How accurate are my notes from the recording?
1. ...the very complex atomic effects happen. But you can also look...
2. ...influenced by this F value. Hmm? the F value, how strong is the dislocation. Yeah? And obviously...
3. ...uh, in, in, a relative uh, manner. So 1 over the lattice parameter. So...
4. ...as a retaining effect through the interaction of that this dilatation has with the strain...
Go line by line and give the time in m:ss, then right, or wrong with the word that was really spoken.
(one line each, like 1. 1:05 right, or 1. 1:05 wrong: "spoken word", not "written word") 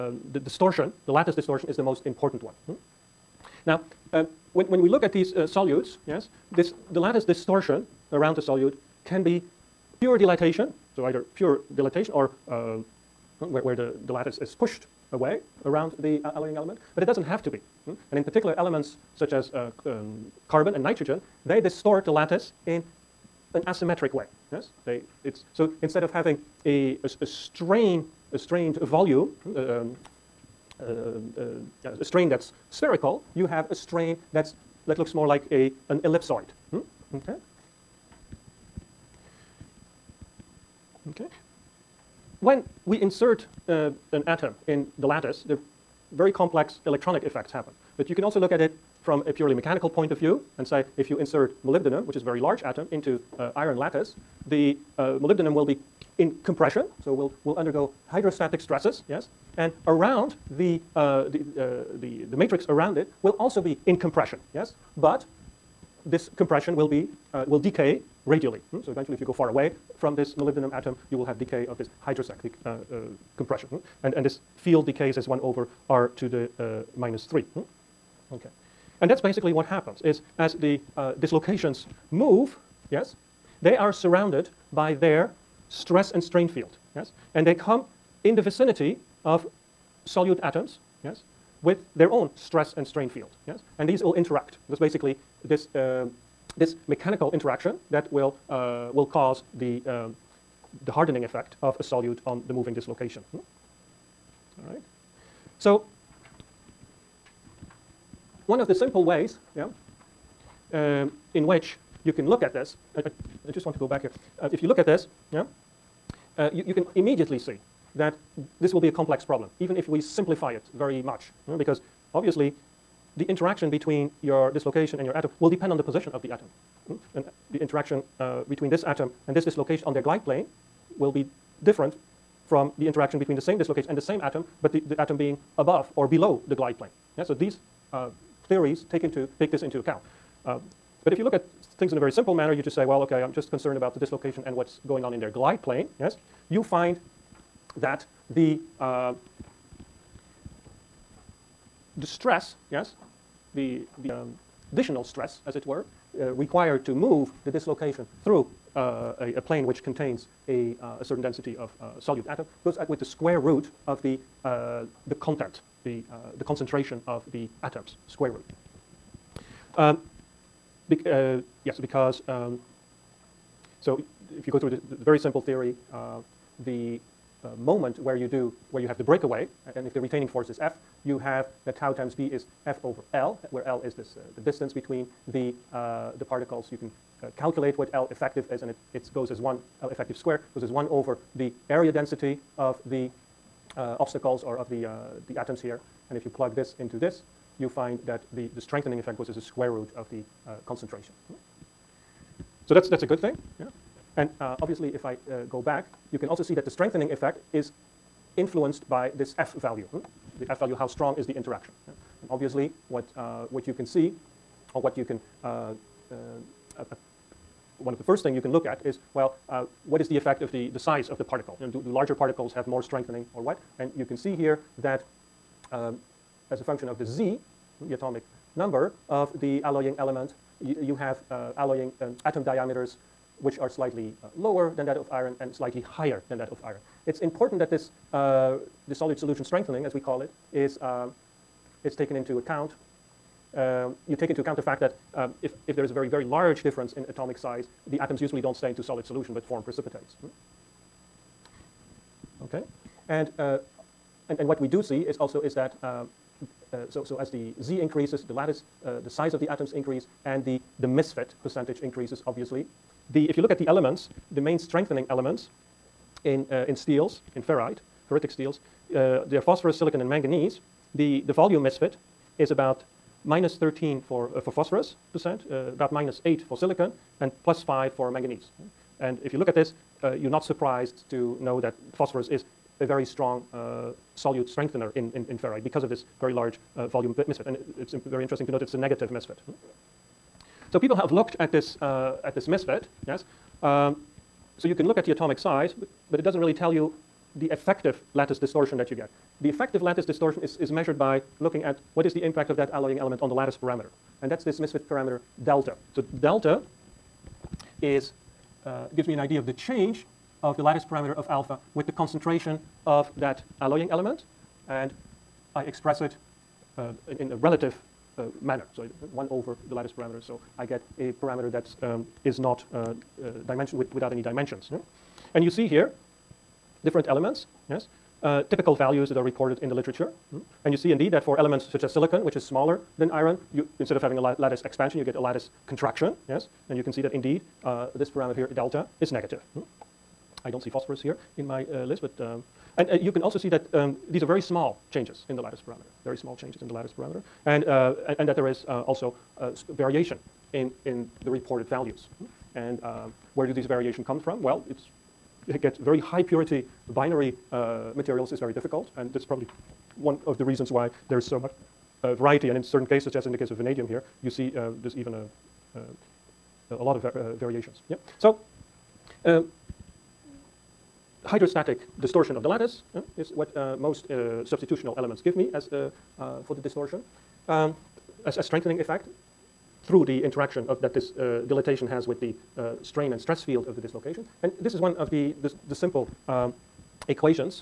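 1. 0:45 wrong: "electronic", not "atomic"
2. 3:28 wrong: "interaction", not "dislocation"
3. 5:16 right
4. 6:18 wrong: "strengthening", not "retaining".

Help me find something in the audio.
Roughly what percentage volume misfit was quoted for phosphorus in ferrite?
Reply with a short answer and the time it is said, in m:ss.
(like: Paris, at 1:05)
-13%, at 4:33.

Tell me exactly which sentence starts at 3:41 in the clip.
You know, do, do larger particles have more strengthening or what?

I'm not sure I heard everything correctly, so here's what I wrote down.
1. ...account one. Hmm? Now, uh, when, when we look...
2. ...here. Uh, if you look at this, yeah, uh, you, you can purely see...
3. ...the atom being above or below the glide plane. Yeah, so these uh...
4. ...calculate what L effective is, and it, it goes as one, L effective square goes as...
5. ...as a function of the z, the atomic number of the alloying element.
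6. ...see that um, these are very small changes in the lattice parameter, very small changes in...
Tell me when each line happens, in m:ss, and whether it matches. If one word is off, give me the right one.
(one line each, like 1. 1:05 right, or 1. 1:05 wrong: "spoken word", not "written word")
1. 0:02 wrong: "important", not "account"
2. 1:54 wrong: "immediately", not "purely"
3. 2:14 right
4. 3:07 right
5. 3:46 right
6. 5:43 right.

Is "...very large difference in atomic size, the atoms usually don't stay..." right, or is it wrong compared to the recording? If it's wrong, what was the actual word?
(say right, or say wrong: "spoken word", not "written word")
right.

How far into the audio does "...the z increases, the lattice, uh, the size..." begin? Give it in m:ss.
4:17.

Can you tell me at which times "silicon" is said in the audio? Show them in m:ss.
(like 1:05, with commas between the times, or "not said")
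4:29, 4:36, 5:31.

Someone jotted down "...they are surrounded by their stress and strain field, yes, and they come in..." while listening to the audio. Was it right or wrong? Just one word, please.
right.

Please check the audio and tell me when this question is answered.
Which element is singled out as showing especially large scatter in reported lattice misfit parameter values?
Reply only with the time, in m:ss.
6:03.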